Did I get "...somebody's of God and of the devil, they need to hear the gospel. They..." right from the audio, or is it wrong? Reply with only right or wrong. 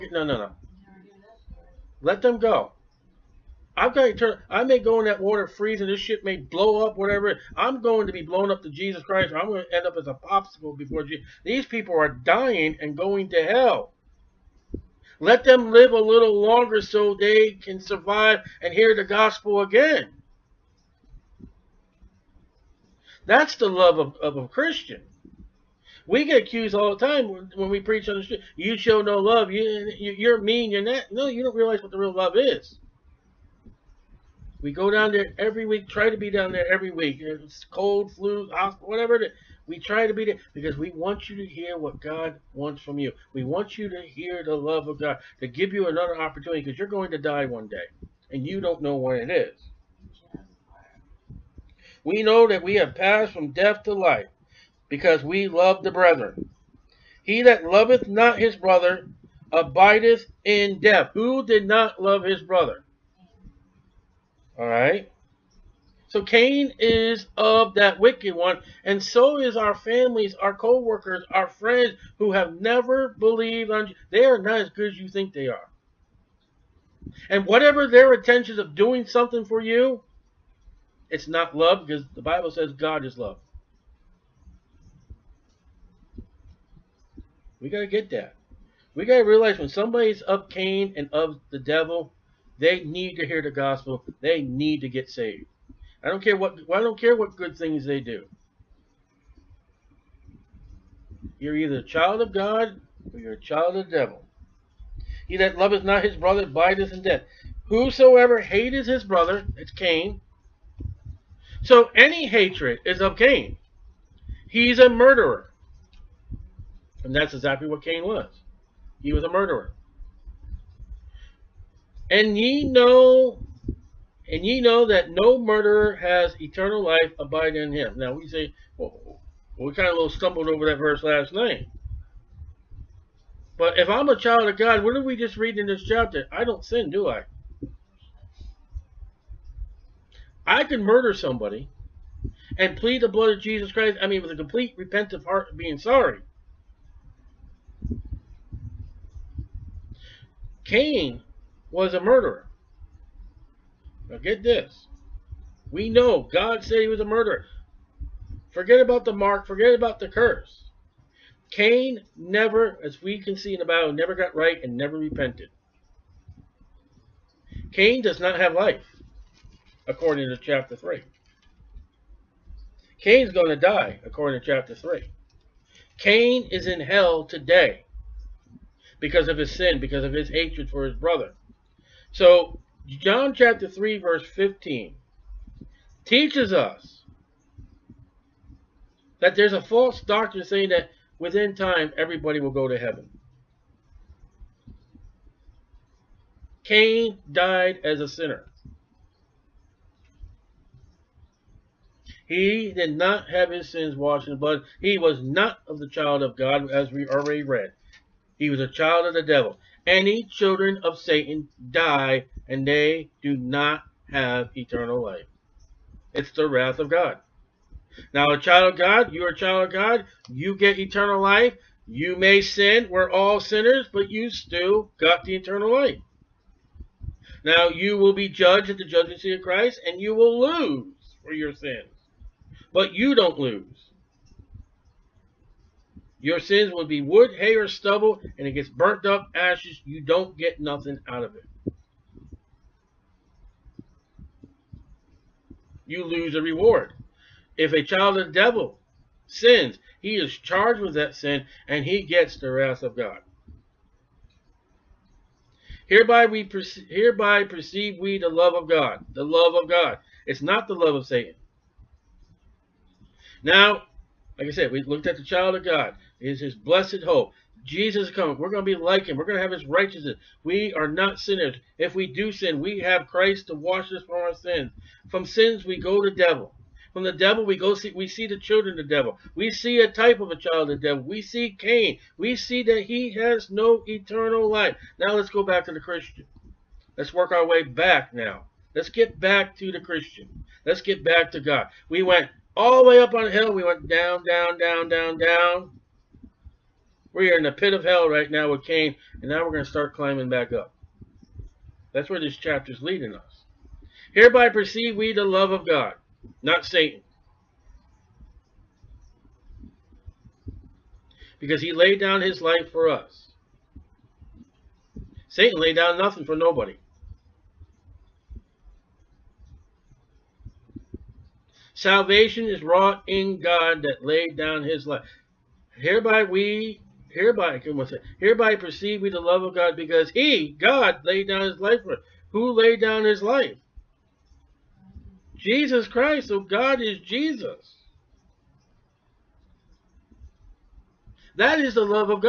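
wrong.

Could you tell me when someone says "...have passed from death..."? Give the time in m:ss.
0:52.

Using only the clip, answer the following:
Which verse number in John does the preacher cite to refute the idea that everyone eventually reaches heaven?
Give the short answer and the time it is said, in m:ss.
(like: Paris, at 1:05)
15, at 3:04.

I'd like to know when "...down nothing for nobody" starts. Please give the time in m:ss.
5:15.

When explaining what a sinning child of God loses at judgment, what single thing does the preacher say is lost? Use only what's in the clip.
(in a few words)
a reward.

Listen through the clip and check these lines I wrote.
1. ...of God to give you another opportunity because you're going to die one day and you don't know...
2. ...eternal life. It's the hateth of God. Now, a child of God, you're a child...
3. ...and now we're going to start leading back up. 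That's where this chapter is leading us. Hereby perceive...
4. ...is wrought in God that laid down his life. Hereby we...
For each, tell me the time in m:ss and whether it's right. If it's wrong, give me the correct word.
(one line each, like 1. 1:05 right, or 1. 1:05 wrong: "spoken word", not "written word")
1. 0:44 right
2. 3:34 wrong: "wrath", not "hateth"
3. 4:59 wrong: "climbing", not "leading"
4. 5:22 right.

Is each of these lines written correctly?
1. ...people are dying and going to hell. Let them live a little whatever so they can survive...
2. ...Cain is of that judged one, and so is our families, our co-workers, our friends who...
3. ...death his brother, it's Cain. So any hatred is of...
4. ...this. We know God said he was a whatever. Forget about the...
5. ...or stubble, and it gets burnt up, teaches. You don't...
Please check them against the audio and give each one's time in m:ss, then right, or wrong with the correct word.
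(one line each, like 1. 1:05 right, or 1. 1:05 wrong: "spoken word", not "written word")
1. 0:11 wrong: "longer", not "whatever"
2. 1:06 wrong: "wicked", not "judged"
3. 1:48 wrong: "hateth", not "death"
4. 2:34 wrong: "murderer", not "whatever"
5. 3:57 wrong: "ashes", not "teaches".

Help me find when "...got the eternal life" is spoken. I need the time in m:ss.
3:44.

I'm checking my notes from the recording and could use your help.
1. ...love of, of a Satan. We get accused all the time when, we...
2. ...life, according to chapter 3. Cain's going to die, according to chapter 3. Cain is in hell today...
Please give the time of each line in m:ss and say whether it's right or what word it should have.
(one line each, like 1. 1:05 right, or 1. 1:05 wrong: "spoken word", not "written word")
1. 0:23 wrong: "Christian", not "Satan"
2. 2:48 right.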